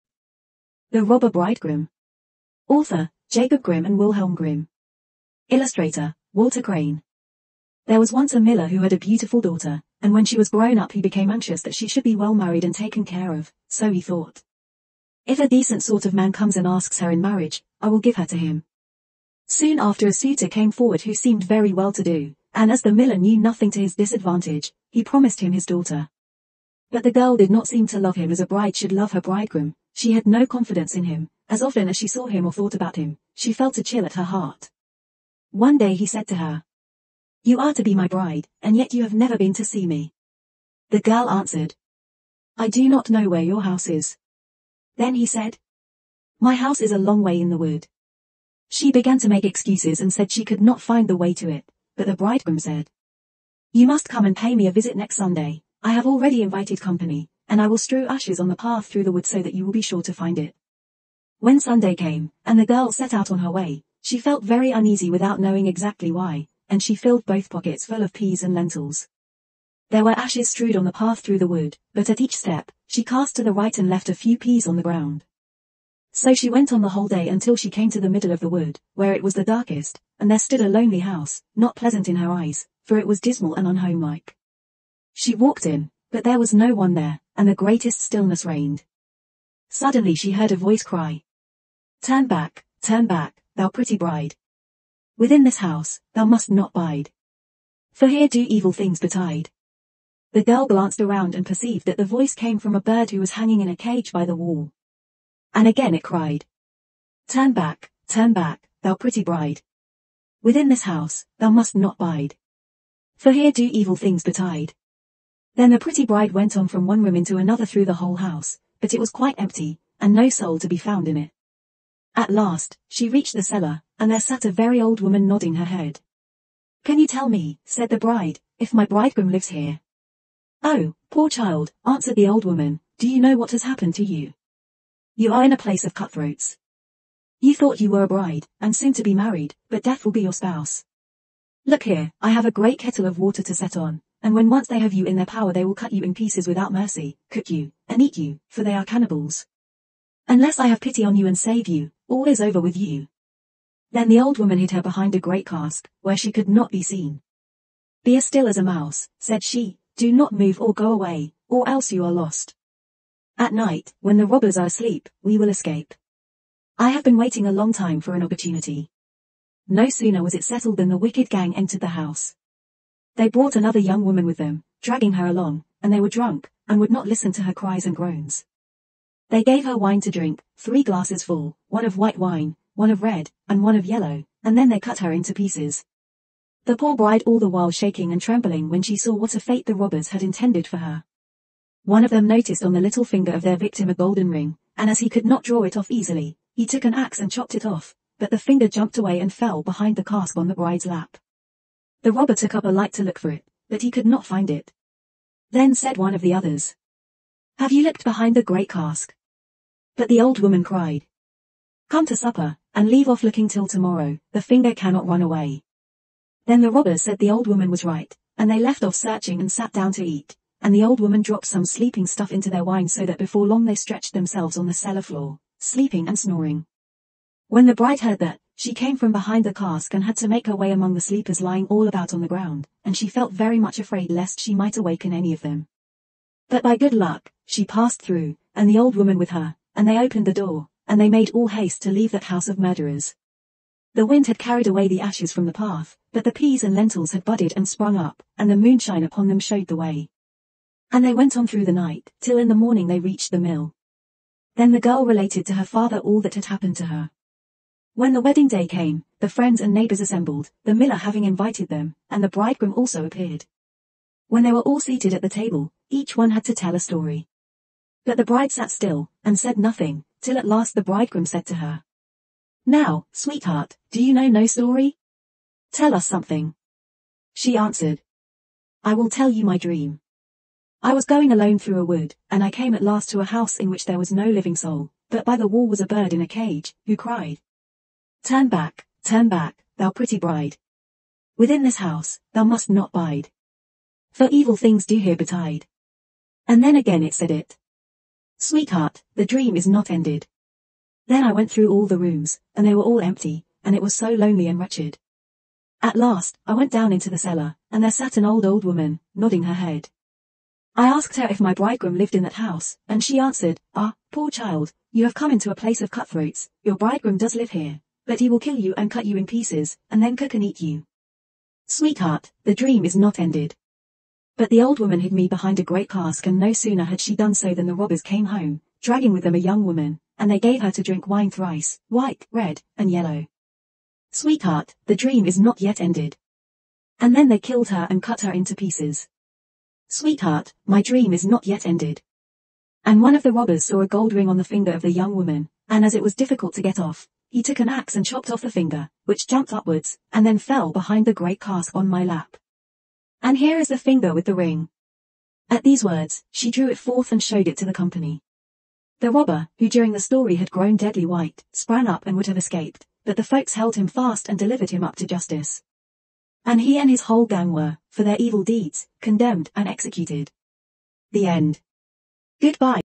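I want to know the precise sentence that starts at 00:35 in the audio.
One day he said to her, You are to be my bride, and yet you have never been to see me.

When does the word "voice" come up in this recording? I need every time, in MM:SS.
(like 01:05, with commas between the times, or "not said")
01:30, 01:42.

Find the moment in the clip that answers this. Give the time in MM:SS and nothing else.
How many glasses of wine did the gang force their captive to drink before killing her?
03:00.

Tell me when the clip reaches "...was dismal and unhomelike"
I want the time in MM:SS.
01:23.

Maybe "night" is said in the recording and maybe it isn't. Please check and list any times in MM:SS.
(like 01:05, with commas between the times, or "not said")
02:43, 04:11.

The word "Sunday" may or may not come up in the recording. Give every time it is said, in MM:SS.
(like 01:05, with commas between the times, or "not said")
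00:55, 01:01.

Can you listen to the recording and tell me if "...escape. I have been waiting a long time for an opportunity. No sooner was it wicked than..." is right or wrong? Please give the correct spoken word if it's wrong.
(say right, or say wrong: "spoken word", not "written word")
wrong: "settled", not "wicked".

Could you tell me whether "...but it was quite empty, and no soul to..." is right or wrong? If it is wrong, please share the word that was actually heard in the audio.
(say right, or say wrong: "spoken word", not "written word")
right.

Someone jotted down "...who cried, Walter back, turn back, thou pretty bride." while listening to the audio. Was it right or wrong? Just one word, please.
wrong.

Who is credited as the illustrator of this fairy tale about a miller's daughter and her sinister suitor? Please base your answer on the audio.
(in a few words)
Walter Crane.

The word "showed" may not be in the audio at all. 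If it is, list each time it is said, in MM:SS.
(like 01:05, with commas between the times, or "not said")
04:09, 05:57.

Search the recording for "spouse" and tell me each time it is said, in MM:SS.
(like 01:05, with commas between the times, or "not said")
02:20.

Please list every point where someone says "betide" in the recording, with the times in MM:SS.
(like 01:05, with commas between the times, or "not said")
01:38, 01:54, 04:55.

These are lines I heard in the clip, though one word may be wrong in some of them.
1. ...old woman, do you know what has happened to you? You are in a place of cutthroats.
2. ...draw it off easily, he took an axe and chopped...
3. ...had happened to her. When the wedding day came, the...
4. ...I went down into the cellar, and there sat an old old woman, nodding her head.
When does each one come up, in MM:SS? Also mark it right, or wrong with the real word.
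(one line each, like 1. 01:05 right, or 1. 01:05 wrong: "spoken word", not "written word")
1. 02:12 right
2. 03:15 right
3. 04:16 right
4. 05:06 right.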